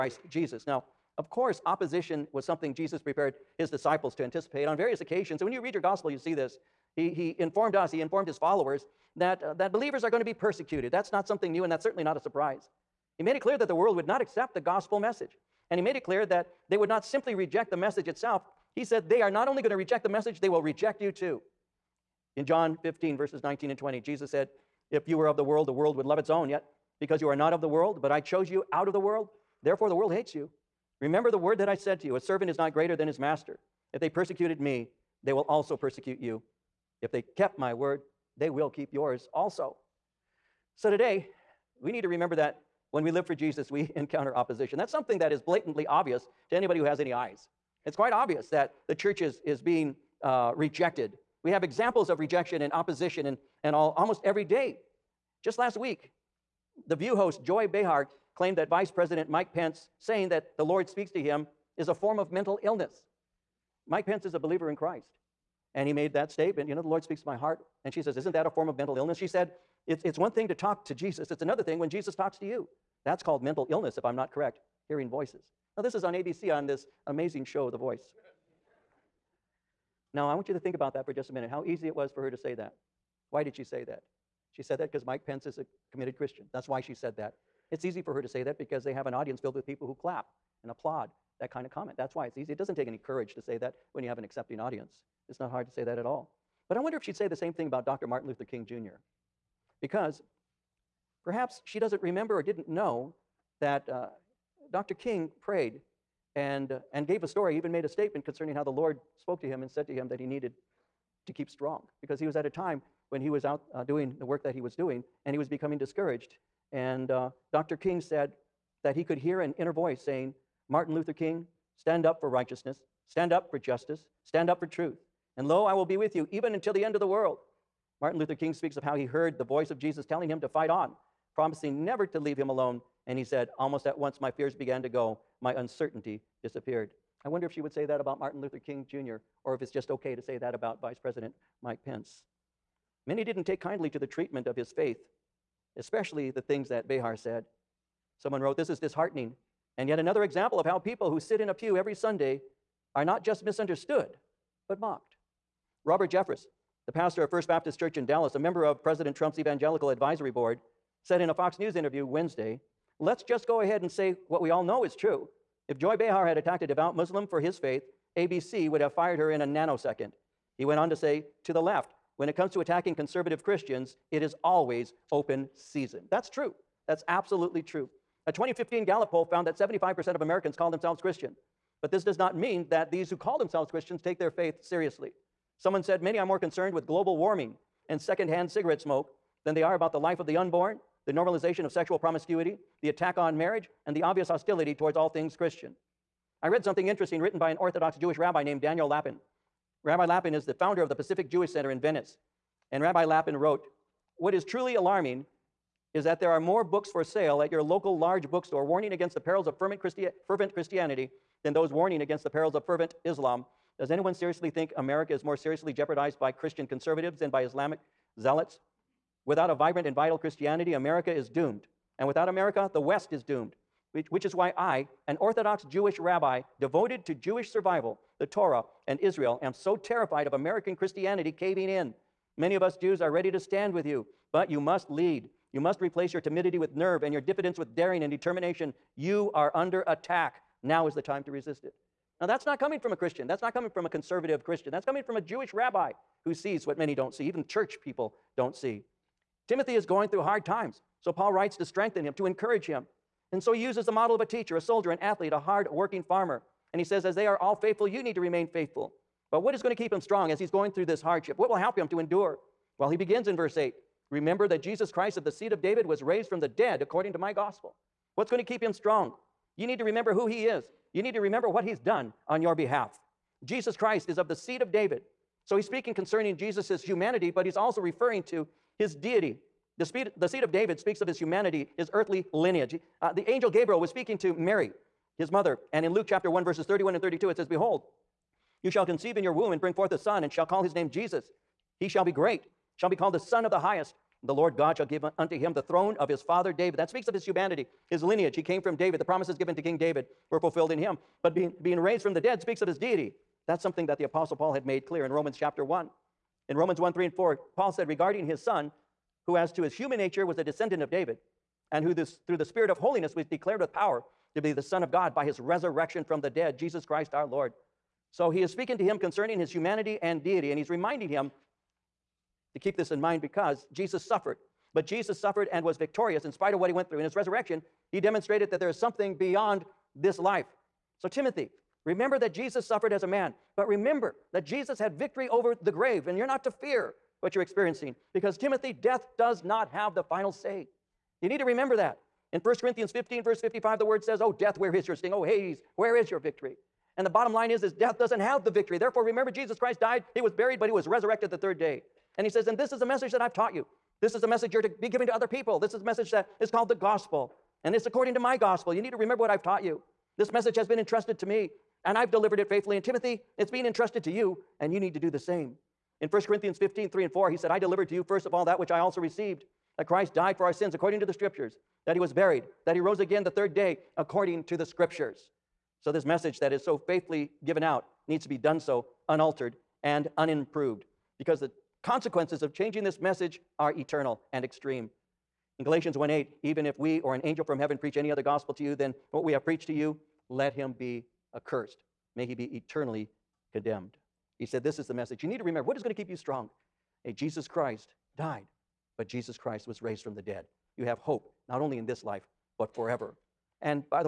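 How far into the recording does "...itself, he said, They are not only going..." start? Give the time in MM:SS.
00:18.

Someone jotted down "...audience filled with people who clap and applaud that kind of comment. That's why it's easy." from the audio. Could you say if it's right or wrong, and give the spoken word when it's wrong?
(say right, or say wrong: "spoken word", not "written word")
right.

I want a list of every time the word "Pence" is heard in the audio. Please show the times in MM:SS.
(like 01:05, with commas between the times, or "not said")
00:59, 01:04, 01:25, 02:21.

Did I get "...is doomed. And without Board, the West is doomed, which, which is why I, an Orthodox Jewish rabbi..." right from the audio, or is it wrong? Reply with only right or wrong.
wrong.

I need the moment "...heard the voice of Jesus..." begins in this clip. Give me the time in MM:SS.
02:09.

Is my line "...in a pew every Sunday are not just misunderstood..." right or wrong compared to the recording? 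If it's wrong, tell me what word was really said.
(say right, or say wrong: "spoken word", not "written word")
right.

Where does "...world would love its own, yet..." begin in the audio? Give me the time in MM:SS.
00:25.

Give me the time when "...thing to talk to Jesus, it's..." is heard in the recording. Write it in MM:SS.
01:10.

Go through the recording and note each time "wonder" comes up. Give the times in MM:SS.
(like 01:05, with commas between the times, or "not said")
01:36, 02:17.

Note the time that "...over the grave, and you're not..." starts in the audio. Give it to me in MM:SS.
05:35.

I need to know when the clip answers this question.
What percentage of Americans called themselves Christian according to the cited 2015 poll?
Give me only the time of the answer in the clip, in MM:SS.
02:59.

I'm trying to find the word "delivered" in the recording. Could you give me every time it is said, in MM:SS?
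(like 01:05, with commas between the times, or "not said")
06:02, 06:07.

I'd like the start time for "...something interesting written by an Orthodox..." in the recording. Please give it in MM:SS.
03:16.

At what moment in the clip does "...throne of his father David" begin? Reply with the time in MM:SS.
04:55.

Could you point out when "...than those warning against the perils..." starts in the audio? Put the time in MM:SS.
03:31.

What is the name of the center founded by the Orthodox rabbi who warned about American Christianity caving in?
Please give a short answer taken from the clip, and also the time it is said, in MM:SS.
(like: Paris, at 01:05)
Pacific Jewish Center, at 03:20.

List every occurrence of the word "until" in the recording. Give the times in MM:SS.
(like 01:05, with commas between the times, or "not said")
02:06.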